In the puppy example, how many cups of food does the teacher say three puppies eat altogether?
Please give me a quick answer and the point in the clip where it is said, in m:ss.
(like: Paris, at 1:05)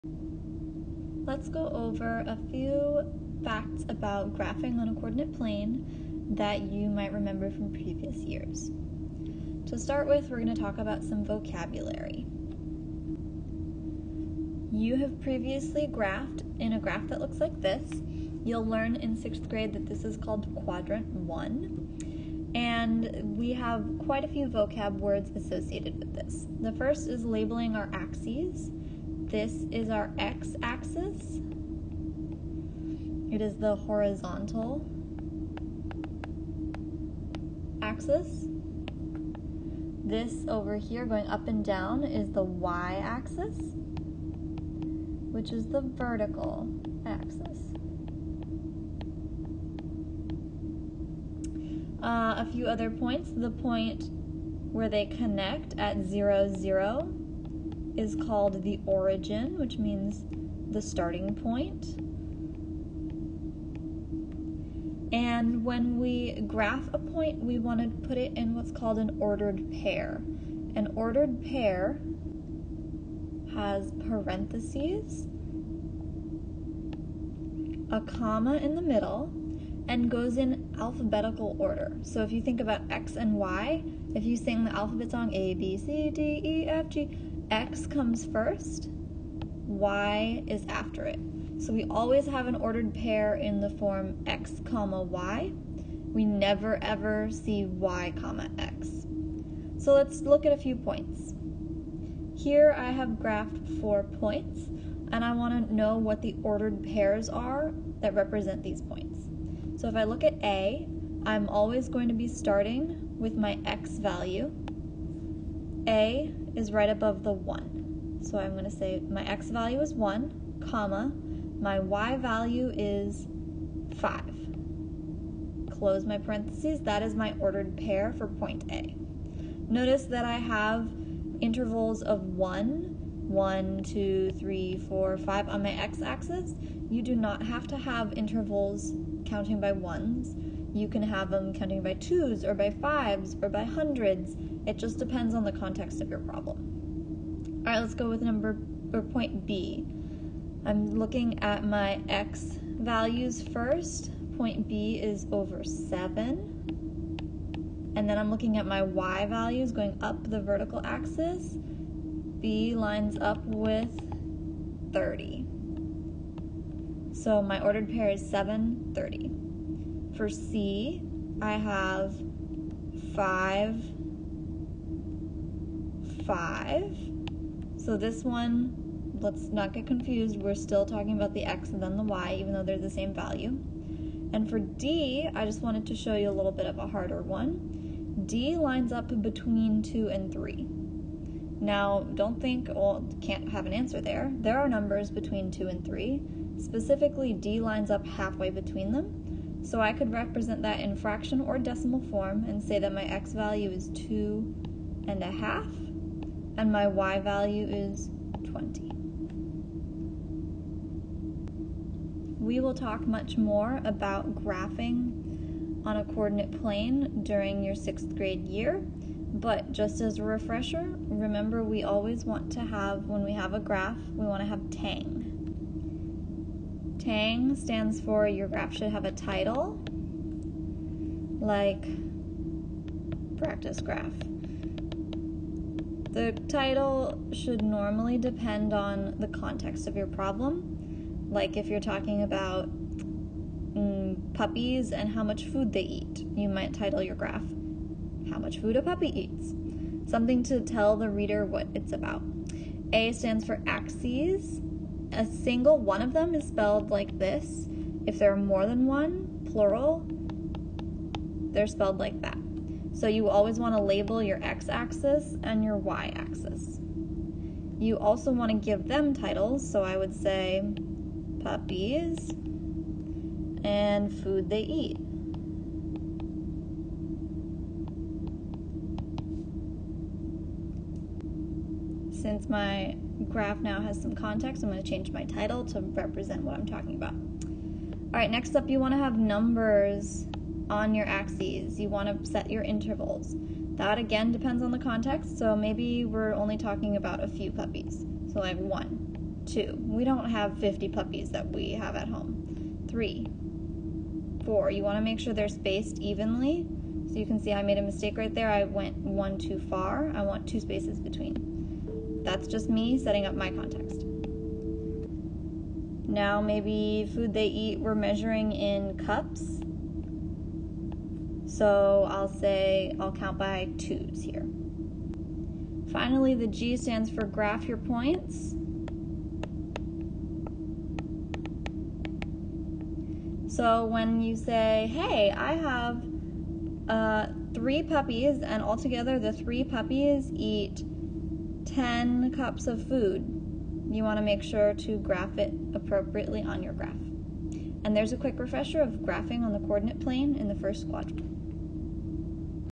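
10, at 5:41.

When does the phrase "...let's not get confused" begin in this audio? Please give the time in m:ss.
2:59.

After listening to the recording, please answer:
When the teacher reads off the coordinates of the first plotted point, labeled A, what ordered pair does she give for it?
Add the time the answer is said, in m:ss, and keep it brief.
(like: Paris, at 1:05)
(1, 5), at 1:59.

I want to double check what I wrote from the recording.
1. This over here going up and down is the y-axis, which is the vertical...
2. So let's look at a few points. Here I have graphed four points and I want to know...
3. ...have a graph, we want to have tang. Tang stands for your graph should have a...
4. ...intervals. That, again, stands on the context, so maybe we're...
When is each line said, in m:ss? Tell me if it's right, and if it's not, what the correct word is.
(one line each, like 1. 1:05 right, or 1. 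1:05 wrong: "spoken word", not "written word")
1. 0:40 right
2. 1:39 right
3. 3:43 right
4. 4:52 wrong: "depends", not "stands".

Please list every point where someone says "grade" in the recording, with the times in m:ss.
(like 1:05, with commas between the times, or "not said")
0:19, 3:38.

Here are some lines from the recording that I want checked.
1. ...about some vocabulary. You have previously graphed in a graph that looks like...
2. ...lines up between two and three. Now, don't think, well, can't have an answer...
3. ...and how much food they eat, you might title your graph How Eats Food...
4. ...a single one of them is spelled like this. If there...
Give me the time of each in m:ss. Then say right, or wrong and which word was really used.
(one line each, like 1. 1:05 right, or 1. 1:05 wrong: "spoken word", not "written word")
1. 0:10 right
2. 3:08 right
3. 4:04 wrong: "Much", not "Eats"
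4. 4:15 right.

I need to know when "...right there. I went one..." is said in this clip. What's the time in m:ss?
5:08.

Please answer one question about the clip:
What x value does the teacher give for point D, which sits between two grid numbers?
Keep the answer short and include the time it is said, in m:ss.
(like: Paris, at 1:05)
2 and a half, at 3:23.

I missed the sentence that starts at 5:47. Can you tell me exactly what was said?
And there's a quick refresher of graphing on the coordinate plane in the first quadrant.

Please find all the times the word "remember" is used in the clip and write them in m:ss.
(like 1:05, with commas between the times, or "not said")
0:07, 3:41.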